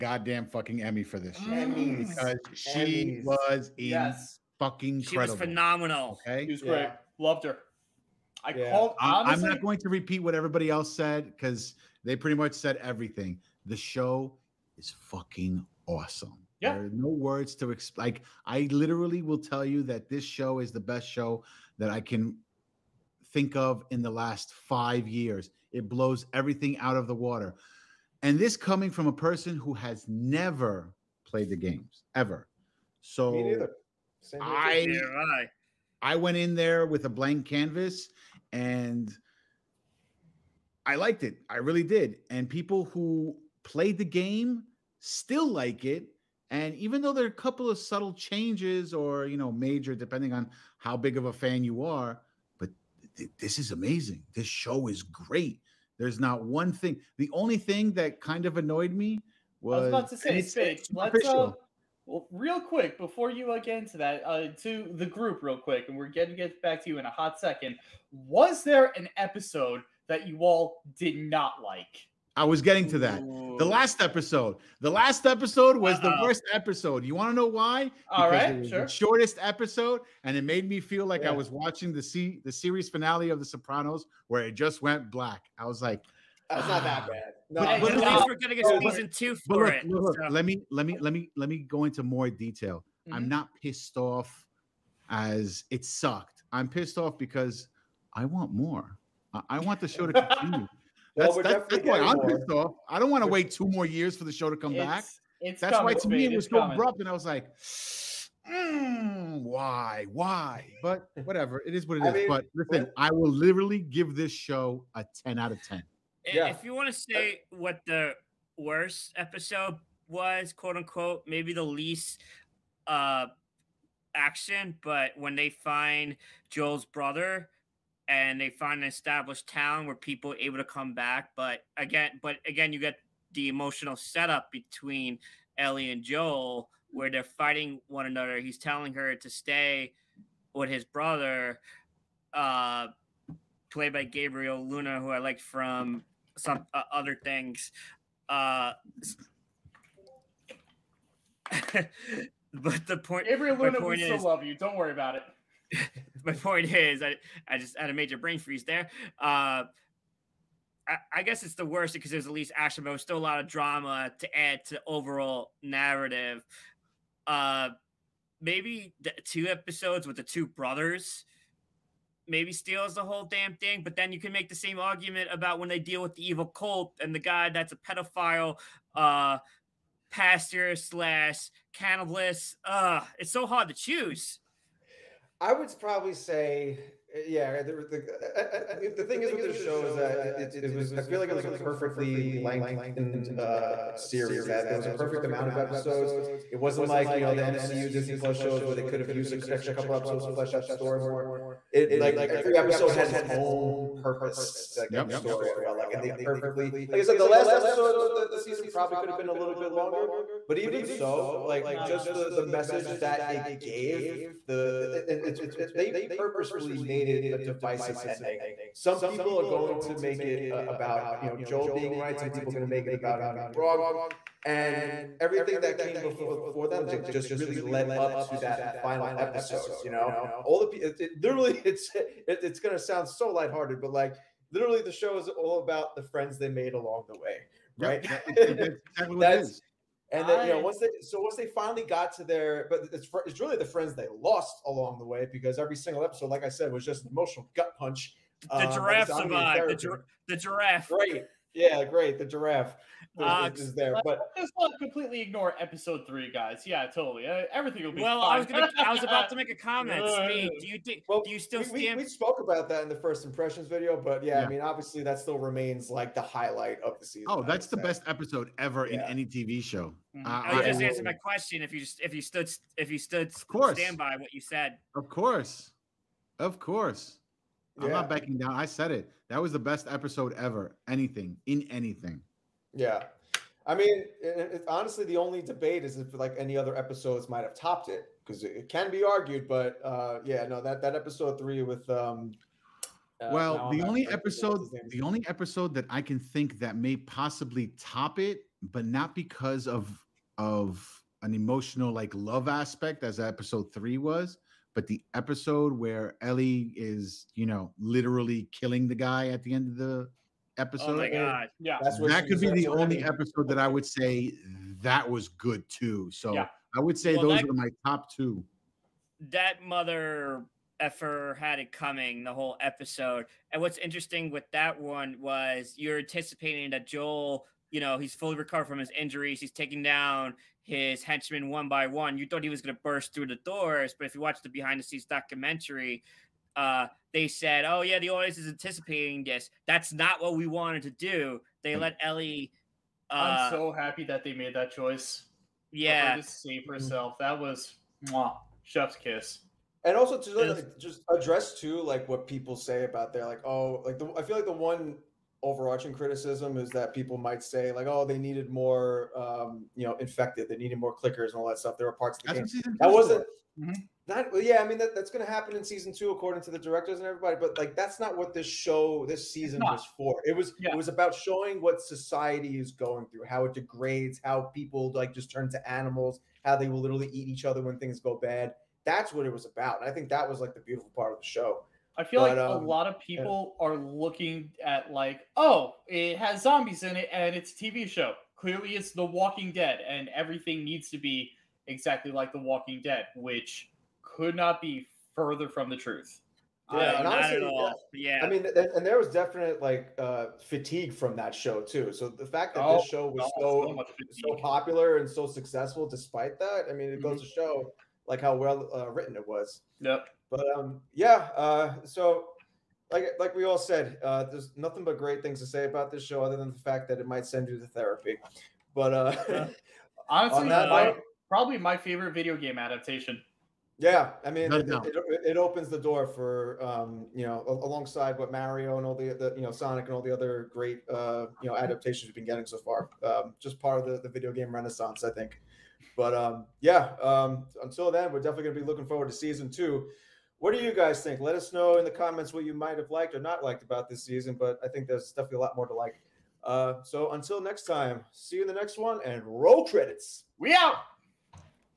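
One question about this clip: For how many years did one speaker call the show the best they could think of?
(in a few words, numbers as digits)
5.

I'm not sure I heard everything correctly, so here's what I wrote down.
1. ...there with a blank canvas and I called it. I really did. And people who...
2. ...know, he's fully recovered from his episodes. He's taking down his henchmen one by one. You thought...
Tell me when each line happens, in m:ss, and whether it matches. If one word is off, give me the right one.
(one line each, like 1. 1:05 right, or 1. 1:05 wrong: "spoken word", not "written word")
1. 0:36 wrong: "liked", not "called"
2. 5:27 wrong: "injuries", not "episodes".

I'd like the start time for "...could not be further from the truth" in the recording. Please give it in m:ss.
6:34.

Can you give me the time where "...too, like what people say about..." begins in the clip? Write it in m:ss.
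5:51.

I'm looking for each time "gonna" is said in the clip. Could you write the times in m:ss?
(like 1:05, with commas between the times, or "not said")
1:28, 4:18.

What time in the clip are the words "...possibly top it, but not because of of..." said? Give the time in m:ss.
4:56.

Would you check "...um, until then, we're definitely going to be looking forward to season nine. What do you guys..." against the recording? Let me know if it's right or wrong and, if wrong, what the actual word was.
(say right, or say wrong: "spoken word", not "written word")
wrong: "two", not "nine".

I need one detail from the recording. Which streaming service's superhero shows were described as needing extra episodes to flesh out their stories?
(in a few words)
Disney Plus.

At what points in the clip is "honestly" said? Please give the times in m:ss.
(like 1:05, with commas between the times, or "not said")
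4:44, 6:37, 7:00.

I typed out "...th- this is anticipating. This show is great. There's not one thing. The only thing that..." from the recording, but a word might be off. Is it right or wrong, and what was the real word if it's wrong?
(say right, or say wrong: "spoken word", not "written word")
wrong: "amazing", not "anticipating".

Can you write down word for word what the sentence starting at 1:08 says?
Was there an episode that you all did not like?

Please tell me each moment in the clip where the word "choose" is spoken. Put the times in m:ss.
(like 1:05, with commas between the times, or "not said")
3:03.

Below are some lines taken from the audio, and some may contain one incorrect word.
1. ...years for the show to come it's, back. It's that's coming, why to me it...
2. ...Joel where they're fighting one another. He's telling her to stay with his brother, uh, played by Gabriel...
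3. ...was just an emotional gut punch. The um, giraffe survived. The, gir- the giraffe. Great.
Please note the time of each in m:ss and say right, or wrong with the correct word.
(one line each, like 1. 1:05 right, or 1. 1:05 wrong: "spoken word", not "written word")
1. 1:43 right
2. 2:16 right
3. 4:06 right.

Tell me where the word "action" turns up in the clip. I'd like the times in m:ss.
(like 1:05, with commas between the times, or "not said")
2:04, 2:42.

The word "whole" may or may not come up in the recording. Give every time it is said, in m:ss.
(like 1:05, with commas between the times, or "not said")
2:53, 5:22.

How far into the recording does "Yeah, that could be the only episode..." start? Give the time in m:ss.
5:11.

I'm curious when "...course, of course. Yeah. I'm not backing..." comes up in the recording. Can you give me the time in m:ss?
4:35.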